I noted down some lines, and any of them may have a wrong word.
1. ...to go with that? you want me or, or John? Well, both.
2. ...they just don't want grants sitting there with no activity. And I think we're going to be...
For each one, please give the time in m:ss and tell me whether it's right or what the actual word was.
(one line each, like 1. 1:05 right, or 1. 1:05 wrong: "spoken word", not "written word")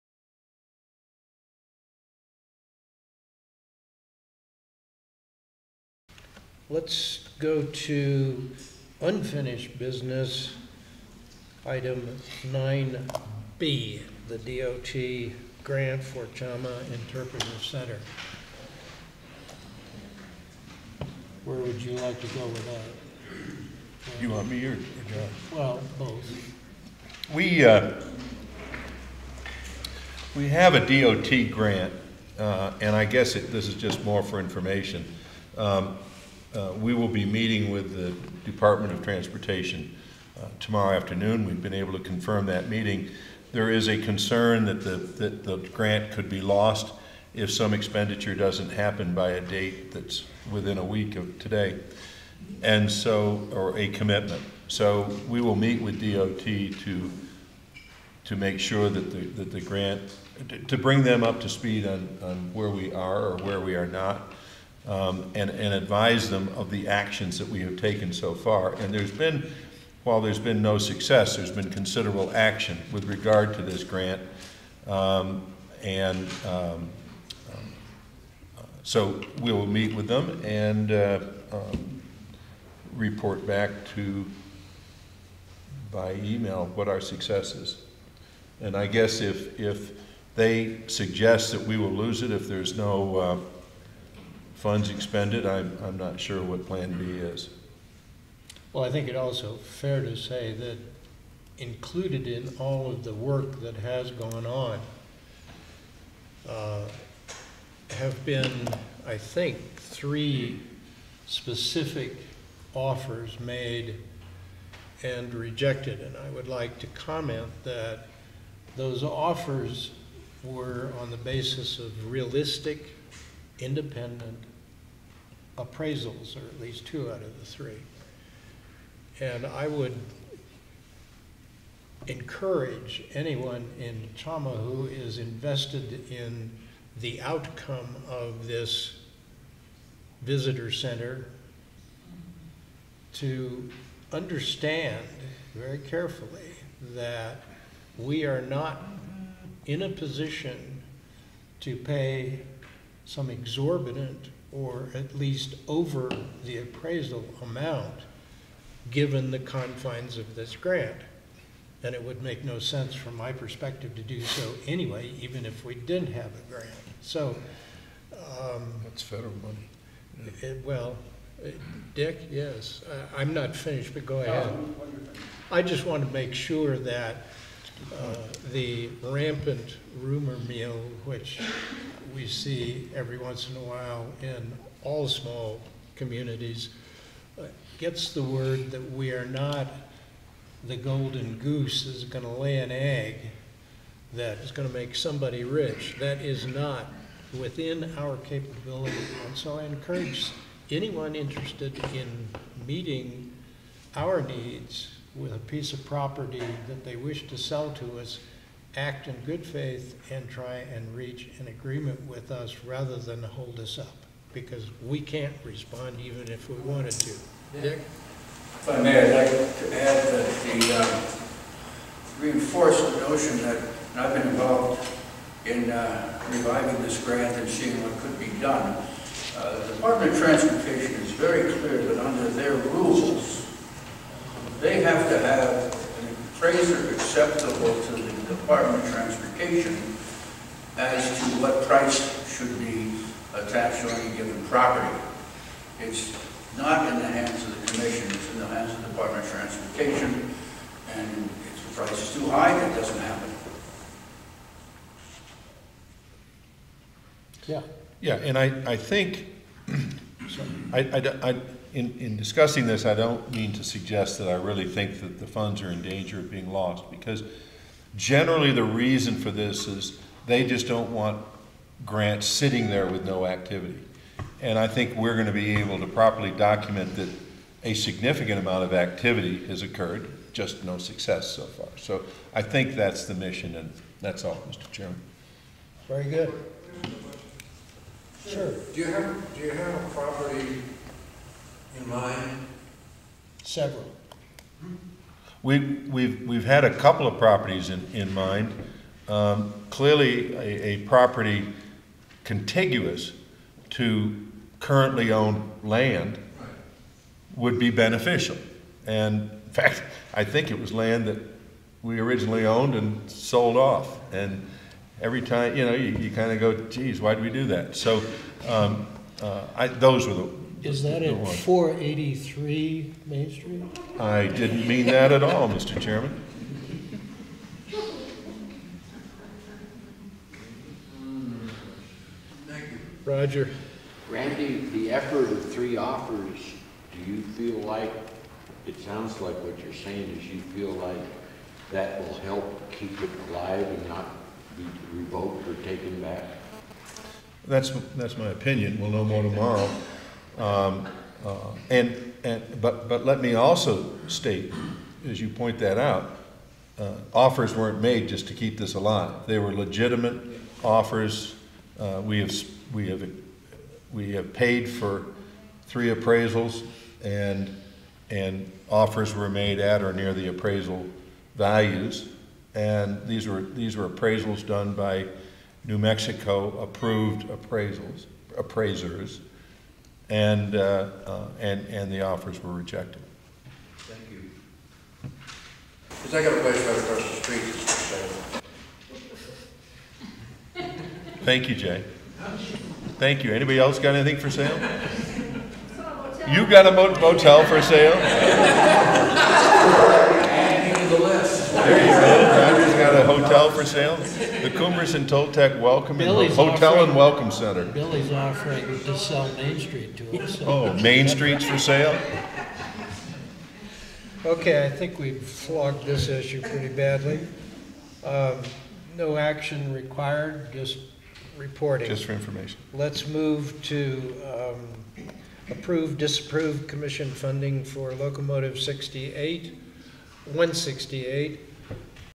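1. 0:22 right
2. 4:30 right.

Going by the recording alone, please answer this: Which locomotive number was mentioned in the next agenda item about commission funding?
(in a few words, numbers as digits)
168.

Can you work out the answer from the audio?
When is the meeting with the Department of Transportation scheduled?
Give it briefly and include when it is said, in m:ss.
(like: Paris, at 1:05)
Tomorrow afternoon, at 0:40.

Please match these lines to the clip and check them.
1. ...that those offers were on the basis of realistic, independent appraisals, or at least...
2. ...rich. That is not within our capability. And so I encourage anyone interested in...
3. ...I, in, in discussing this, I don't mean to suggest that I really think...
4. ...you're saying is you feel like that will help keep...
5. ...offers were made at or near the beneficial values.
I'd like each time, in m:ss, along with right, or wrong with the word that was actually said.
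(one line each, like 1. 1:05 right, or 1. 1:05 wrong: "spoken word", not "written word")
1. 1:57 right
2. 3:15 right
3. 4:21 right
4. 5:39 right
5. 6:08 wrong: "appraisal", not "beneficial".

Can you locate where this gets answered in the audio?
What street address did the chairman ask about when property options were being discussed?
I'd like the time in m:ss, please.
5:21.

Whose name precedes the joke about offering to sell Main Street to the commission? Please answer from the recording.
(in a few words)
Billy.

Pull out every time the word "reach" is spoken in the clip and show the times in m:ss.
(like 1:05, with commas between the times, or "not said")
3:30.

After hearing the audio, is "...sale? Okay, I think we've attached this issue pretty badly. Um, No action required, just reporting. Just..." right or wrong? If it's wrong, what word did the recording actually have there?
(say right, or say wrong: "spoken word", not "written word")
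wrong: "flogged", not "attached".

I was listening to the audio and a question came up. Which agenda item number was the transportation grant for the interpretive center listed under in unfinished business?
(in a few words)
9B.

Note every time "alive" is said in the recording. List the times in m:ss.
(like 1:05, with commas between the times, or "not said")
5:43, 5:58.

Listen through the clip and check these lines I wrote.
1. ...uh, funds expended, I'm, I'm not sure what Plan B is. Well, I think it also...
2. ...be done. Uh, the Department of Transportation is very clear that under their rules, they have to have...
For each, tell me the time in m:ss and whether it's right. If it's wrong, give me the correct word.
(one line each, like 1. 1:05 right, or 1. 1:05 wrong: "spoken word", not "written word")
1. 1:33 right
2. 3:48 right.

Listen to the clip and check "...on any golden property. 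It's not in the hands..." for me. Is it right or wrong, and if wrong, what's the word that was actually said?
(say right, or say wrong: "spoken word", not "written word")
wrong: "given", not "golden".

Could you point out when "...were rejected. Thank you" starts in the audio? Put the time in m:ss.
6:22.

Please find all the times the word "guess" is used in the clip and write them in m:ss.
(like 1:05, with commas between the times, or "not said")
0:33, 1:28.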